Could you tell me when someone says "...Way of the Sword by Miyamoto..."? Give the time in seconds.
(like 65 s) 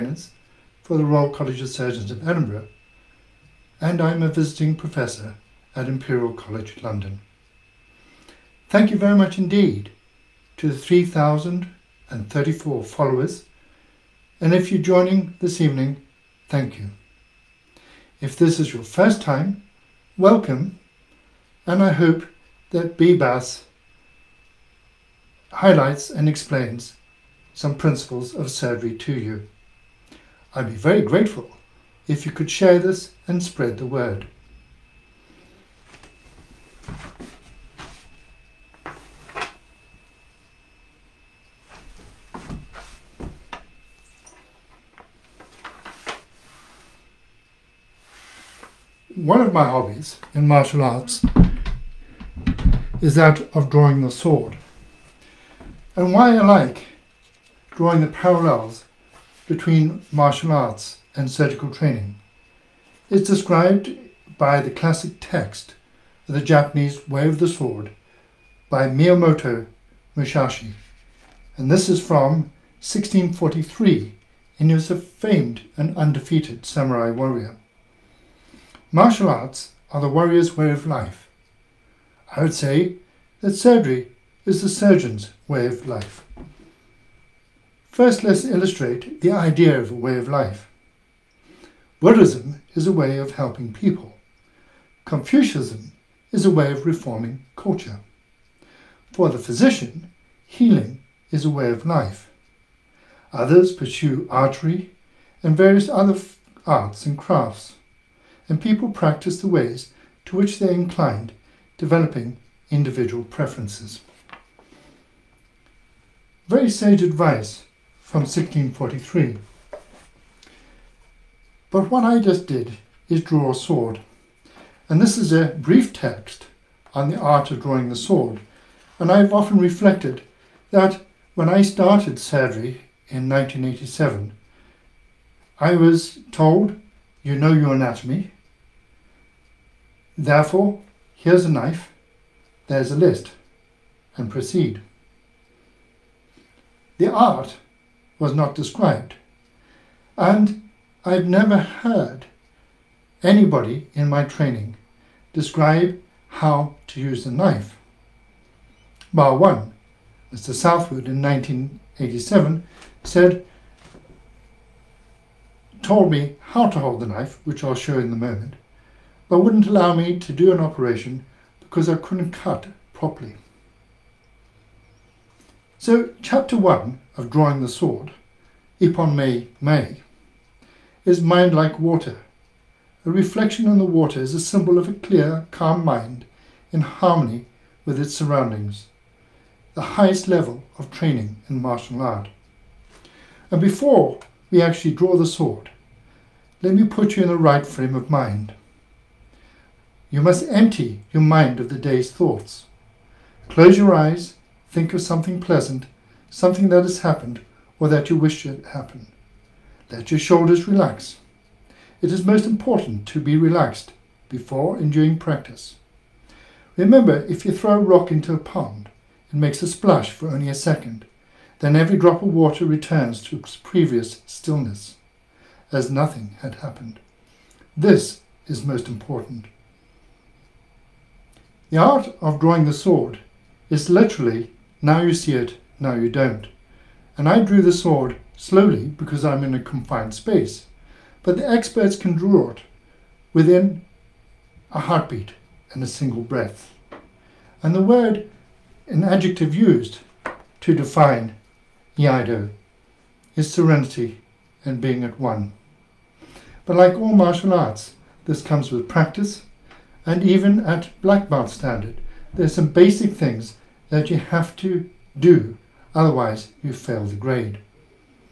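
67 s.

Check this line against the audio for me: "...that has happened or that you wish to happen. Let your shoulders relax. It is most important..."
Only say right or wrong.
right.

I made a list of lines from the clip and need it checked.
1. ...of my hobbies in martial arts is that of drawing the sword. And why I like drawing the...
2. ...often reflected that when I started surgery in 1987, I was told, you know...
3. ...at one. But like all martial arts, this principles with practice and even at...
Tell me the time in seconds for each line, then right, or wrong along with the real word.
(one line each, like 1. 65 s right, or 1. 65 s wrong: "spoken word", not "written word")
1. 49 s right
2. 129 s right
3. 255 s wrong: "comes", not "principles".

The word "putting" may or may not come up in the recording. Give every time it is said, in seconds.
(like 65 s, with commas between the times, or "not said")
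not said.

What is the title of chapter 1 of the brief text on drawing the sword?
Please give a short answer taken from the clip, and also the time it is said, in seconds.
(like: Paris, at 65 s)
Mind Like Water, at 181 s.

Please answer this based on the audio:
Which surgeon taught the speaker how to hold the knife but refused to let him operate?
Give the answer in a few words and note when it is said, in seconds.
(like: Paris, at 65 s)
Mr. Southwood, at 160 s.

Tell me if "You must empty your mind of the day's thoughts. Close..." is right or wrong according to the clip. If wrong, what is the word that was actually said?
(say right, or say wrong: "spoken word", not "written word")
right.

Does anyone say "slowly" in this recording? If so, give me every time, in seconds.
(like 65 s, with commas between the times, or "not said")
238 s.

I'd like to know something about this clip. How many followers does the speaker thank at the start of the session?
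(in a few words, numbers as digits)
3,034.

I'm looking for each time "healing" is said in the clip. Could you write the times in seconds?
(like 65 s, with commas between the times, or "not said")
100 s.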